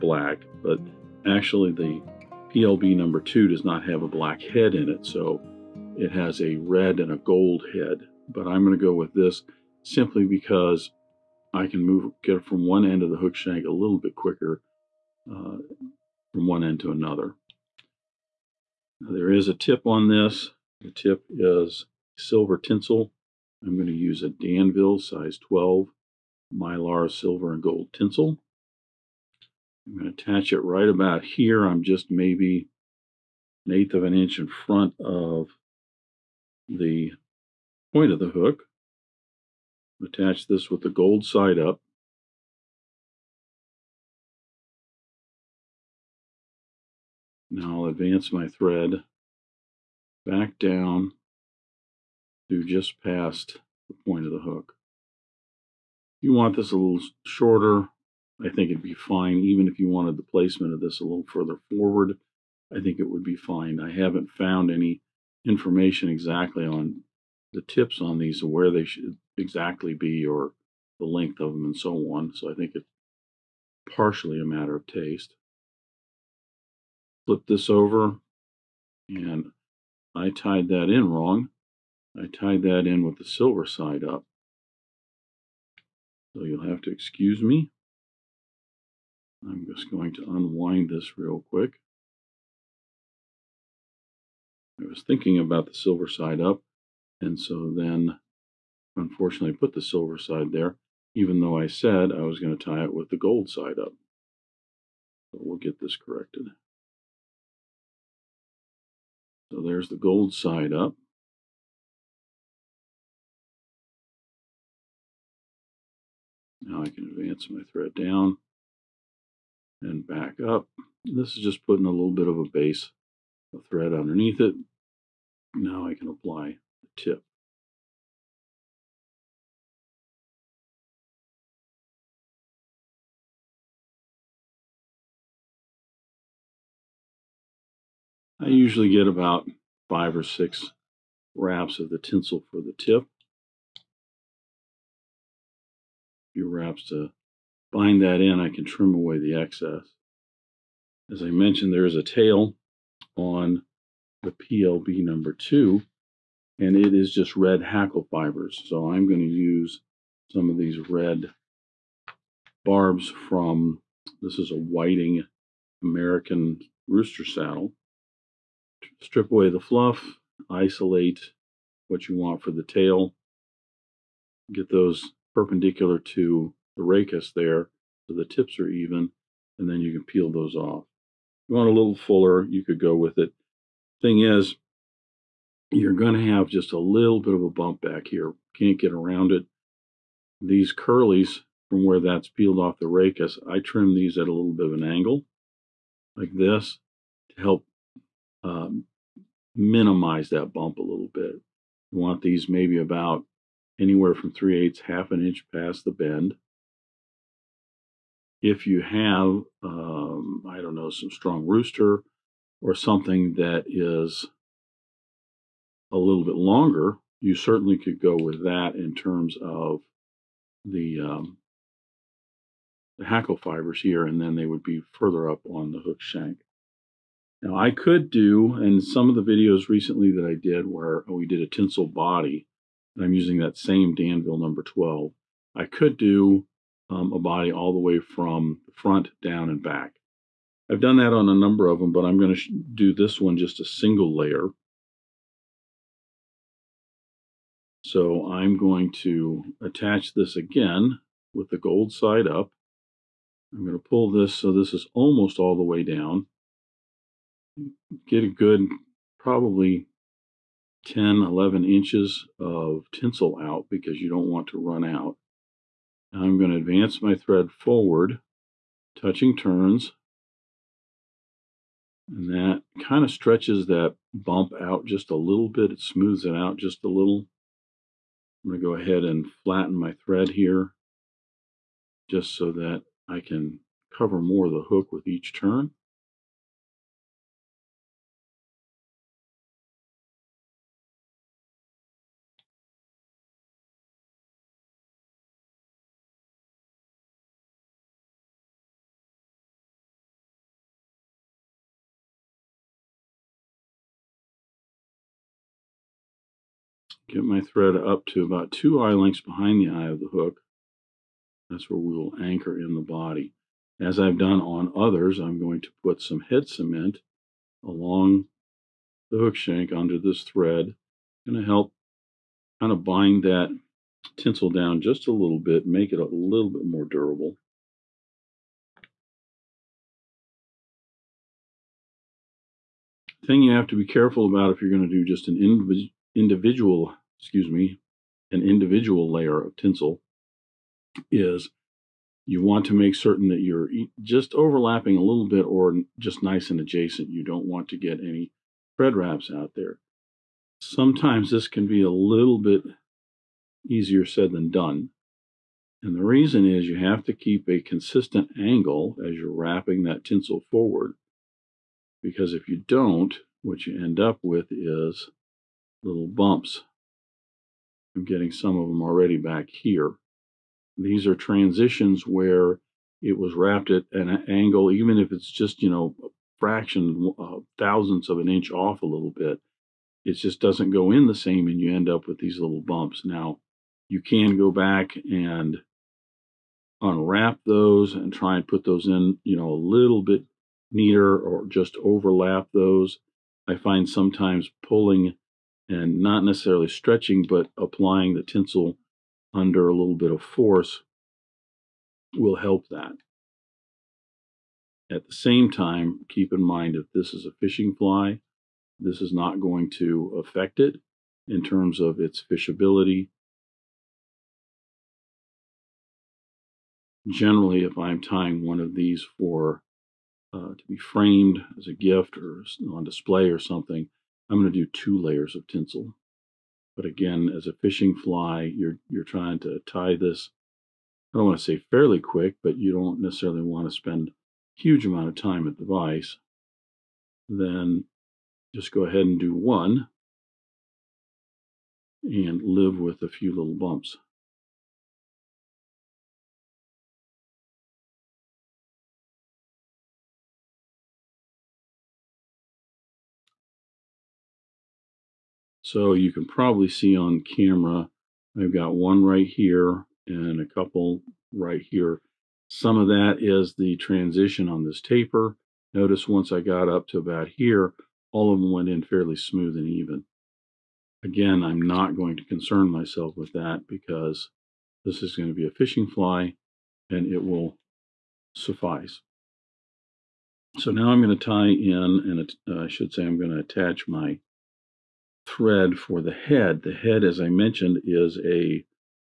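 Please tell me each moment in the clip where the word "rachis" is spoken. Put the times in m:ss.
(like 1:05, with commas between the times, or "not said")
2:56, 3:12.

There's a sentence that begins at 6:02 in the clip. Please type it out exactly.
Because if you don't, what you end up with is little bumps I'm getting some of them already back here.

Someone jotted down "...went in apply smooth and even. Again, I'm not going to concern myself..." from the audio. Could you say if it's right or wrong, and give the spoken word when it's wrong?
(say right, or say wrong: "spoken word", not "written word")
wrong: "fairly", not "apply".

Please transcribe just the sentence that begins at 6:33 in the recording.
I find sometimes pulling and not necessarily stretching, but applying the tinsel under a little bit of force will help that.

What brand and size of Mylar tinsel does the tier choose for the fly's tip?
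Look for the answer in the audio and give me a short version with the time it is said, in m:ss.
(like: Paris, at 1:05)
Danville size 12, at 0:24.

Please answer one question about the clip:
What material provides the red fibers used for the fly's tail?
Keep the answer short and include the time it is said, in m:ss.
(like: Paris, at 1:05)
Whiting American rooster saddle, at 2:44.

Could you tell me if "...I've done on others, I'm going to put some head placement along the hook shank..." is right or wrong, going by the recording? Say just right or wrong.
wrong.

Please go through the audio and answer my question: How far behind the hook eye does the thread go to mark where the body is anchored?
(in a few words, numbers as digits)
2 eye lengths.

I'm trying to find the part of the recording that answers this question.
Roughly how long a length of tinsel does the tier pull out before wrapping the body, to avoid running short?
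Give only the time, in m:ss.
4:20.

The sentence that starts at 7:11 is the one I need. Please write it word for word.
I don't want to say fairly quick, but you don't necessarily want to spend huge amount of time at the vise.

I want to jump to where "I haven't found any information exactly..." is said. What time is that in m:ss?
1:03.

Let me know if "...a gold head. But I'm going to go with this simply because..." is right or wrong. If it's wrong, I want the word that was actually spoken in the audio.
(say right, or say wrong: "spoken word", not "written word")
right.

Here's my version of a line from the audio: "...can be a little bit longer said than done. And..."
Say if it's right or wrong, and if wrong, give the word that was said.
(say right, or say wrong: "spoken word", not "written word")
wrong: "easier", not "longer".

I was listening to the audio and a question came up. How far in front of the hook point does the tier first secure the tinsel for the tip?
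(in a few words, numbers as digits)
an eighth of an inch.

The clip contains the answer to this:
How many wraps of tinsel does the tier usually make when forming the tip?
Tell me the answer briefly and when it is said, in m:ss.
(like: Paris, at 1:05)
5 or 6, at 2:19.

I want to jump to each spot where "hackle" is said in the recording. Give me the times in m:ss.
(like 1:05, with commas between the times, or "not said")
2:37, 3:43.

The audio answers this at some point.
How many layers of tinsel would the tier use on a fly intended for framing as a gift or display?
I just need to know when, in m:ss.
7:04.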